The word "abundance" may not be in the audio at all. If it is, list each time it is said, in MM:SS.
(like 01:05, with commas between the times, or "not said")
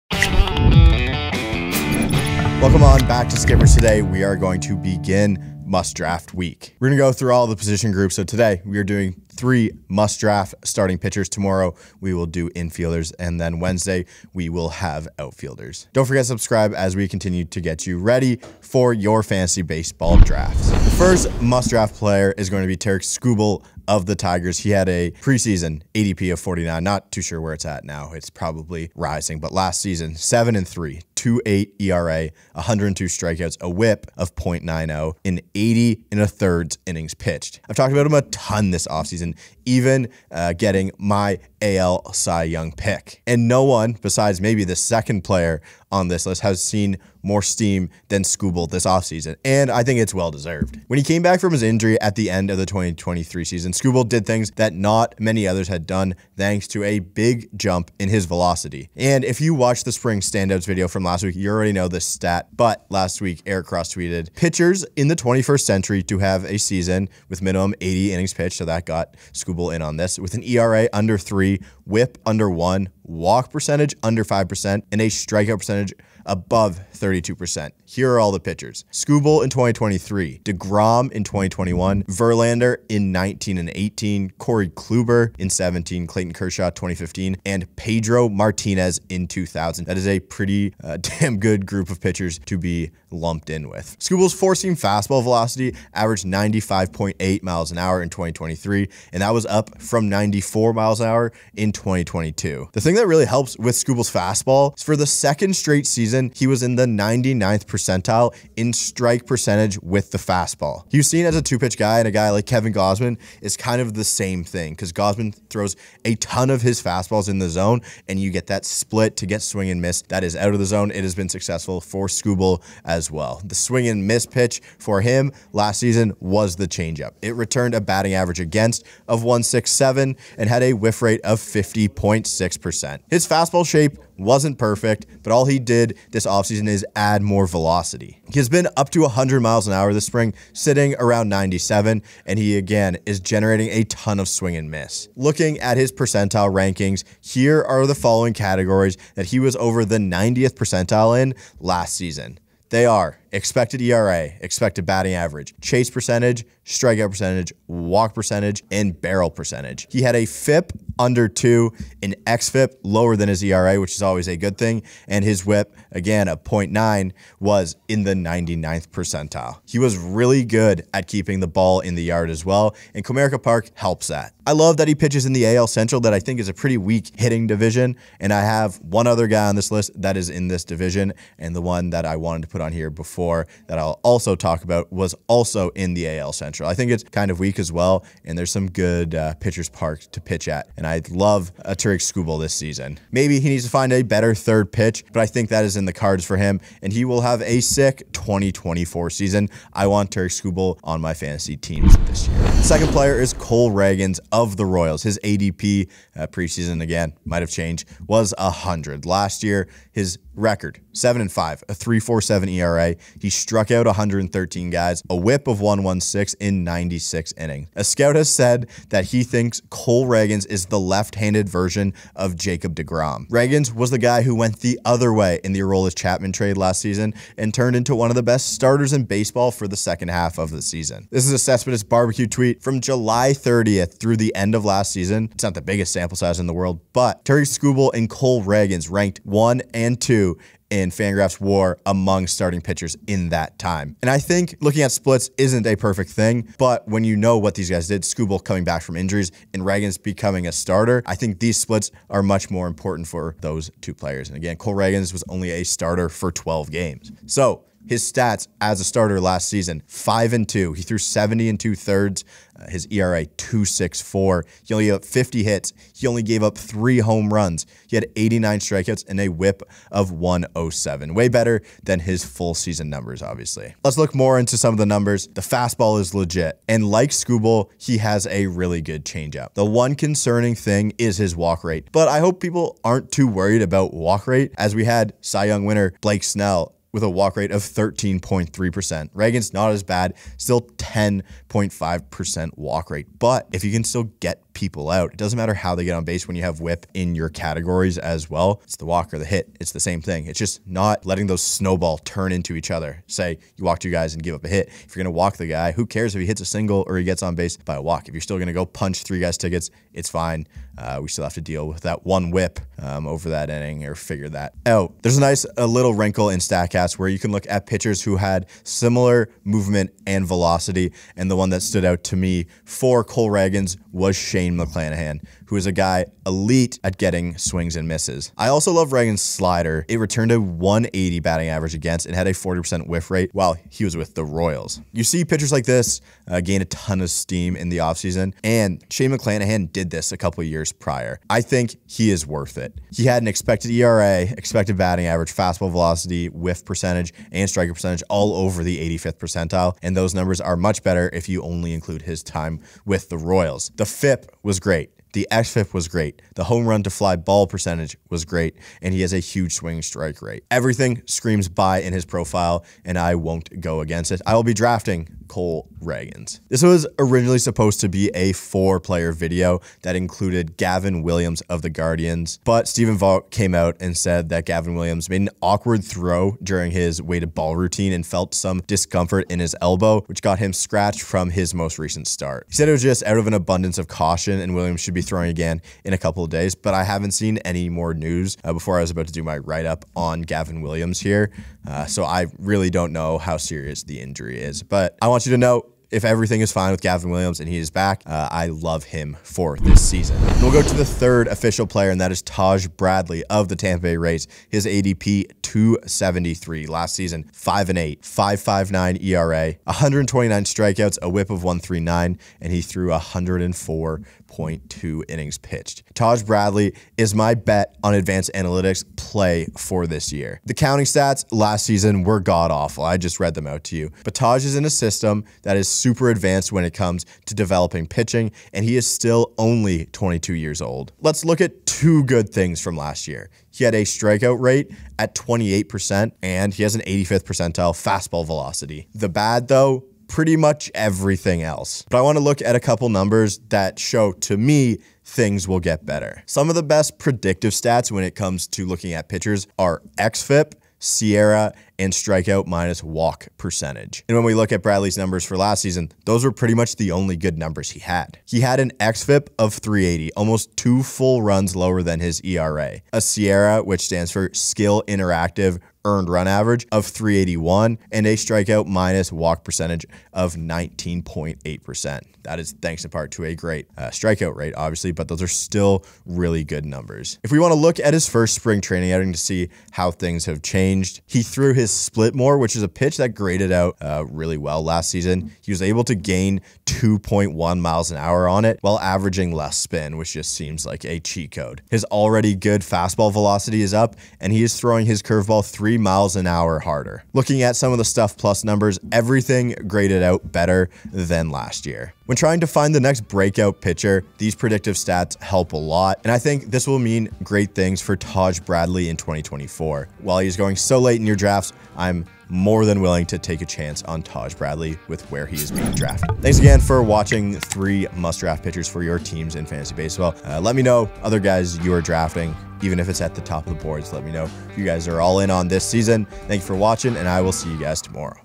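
06:23.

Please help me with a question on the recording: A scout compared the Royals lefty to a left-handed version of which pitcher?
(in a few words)
Jacob DeGrom.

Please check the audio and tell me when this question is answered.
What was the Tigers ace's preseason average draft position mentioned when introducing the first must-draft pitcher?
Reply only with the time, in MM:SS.
00:25.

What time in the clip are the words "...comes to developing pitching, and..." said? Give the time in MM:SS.
07:06.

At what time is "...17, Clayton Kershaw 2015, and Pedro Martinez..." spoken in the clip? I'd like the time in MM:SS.
01:25.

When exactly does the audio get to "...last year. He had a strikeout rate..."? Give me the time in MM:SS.
07:12.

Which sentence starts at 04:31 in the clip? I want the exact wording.
Way better than his full season numbers, obviously.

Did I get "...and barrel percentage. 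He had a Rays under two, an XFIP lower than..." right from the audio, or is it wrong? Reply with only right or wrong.
wrong.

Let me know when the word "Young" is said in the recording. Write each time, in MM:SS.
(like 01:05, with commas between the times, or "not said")
00:42, 04:45.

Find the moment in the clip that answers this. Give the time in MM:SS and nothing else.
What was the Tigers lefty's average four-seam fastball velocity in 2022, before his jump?
01:40.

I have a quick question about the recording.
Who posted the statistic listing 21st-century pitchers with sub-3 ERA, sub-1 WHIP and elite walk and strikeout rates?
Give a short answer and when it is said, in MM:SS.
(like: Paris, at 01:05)
Eric Cross, at 01:03.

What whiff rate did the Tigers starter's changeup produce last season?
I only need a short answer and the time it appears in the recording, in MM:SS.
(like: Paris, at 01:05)
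50.6%, at 02:11.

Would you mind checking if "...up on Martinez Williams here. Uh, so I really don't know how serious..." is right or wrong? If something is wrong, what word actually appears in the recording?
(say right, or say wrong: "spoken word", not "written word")
wrong: "Gavin", not "Martinez".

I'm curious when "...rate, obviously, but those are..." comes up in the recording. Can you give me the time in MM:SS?
07:54.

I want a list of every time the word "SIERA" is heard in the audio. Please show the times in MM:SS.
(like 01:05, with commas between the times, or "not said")
07:30, 07:43.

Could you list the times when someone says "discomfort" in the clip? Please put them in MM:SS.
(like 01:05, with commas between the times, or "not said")
06:18.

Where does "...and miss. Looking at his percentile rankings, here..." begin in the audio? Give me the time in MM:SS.
02:24.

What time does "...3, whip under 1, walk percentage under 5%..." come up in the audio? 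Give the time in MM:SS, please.
01:11.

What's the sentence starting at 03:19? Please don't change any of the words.
I want Tarik Skubal on my fantasy teams this year.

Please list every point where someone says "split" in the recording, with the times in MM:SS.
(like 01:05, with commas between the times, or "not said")
01:58, 04:04, 04:11, 08:01.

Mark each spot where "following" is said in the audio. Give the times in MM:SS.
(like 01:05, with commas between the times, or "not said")
02:27.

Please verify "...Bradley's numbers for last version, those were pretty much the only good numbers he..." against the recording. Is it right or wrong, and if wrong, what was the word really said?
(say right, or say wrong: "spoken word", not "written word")
wrong: "season", not "version".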